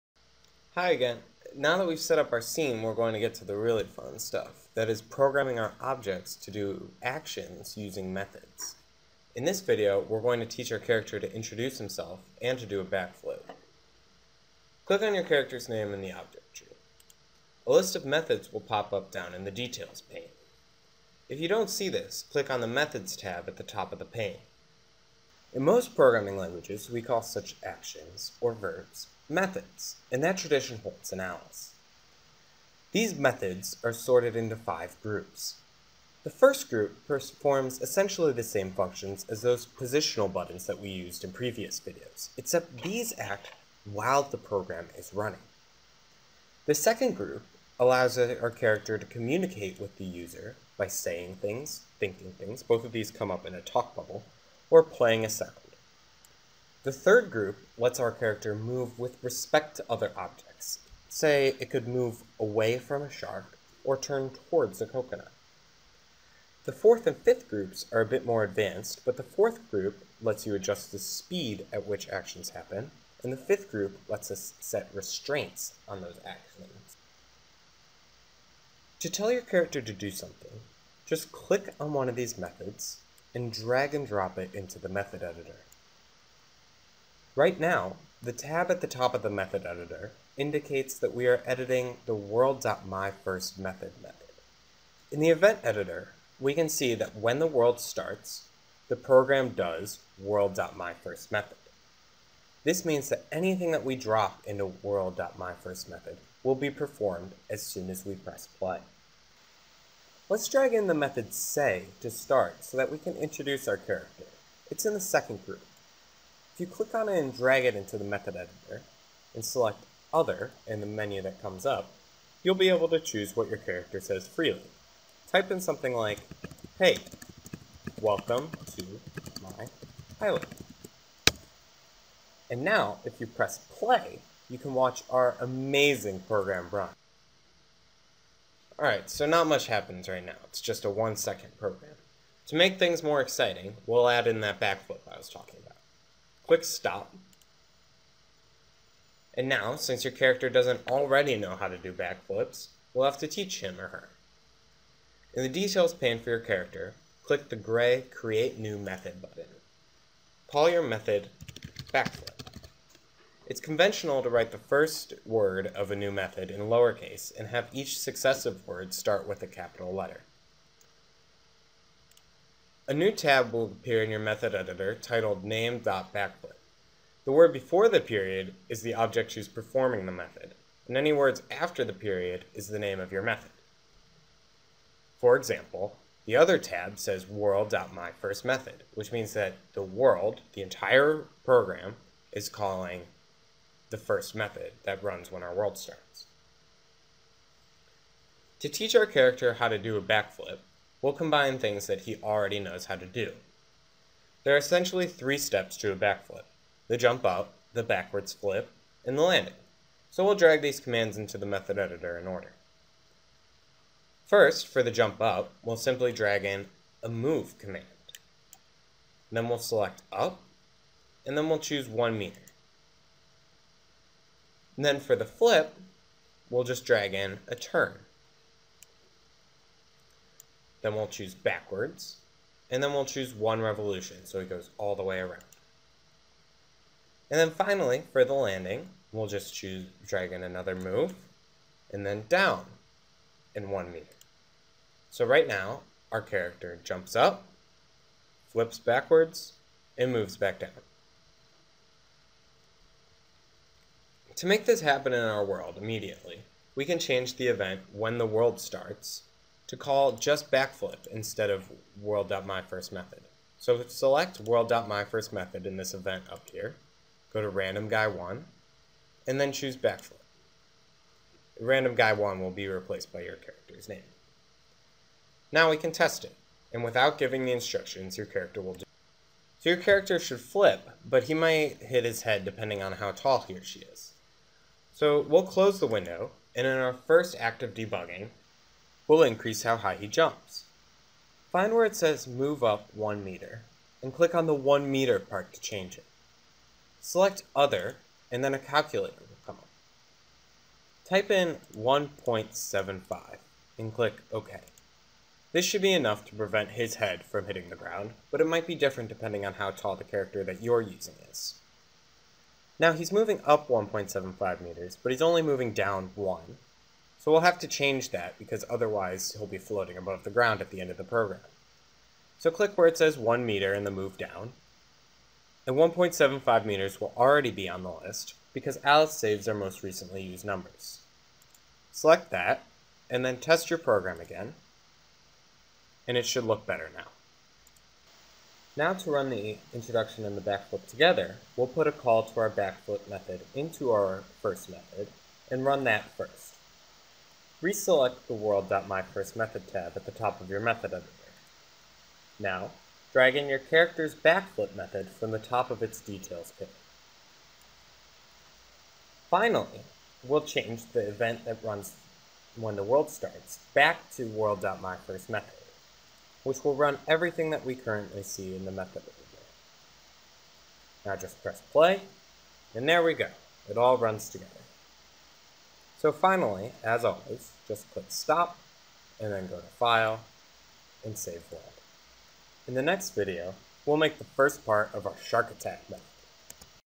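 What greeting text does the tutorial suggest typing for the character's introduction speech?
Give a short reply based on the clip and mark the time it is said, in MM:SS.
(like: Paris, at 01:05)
Hey, welcome to my island, at 02:06.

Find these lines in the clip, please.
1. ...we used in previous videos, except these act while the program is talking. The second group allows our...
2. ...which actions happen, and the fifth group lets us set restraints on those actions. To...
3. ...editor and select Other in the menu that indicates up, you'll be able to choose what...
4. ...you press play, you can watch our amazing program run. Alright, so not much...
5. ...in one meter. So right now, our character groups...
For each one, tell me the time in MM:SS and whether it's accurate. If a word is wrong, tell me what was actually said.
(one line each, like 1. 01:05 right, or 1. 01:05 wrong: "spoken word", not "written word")
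1. 00:40 wrong: "running", not "talking"
2. 01:11 right
3. 01:58 wrong: "comes", not "indicates"
4. 02:13 right
5. 04:03 wrong: "jumps", not "groups".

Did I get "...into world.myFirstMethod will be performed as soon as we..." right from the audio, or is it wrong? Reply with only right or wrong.
right.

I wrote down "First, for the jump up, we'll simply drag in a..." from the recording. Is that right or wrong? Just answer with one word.
right.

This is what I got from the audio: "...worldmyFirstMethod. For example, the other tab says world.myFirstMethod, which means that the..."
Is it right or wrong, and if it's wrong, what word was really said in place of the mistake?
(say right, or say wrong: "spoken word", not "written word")
wrong: "method", not "worldmyFirstMethod".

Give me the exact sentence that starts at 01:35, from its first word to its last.
In the event editor, we can see that when the world starts, the program does world.myFirstMethod.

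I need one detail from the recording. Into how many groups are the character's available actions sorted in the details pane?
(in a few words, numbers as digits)
5.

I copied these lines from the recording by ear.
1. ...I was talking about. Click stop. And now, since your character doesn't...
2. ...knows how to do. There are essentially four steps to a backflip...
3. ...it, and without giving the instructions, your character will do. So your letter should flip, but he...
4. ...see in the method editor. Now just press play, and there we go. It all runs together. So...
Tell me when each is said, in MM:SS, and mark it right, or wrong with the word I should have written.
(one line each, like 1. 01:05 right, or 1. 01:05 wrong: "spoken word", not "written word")
1. 02:25 right
2. 03:22 wrong: "three", not "four"
3. 04:36 wrong: "character", not "letter"
4. 06:08 right.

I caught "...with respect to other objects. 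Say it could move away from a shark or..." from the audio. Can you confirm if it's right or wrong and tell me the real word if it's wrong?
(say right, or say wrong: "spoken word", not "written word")
right.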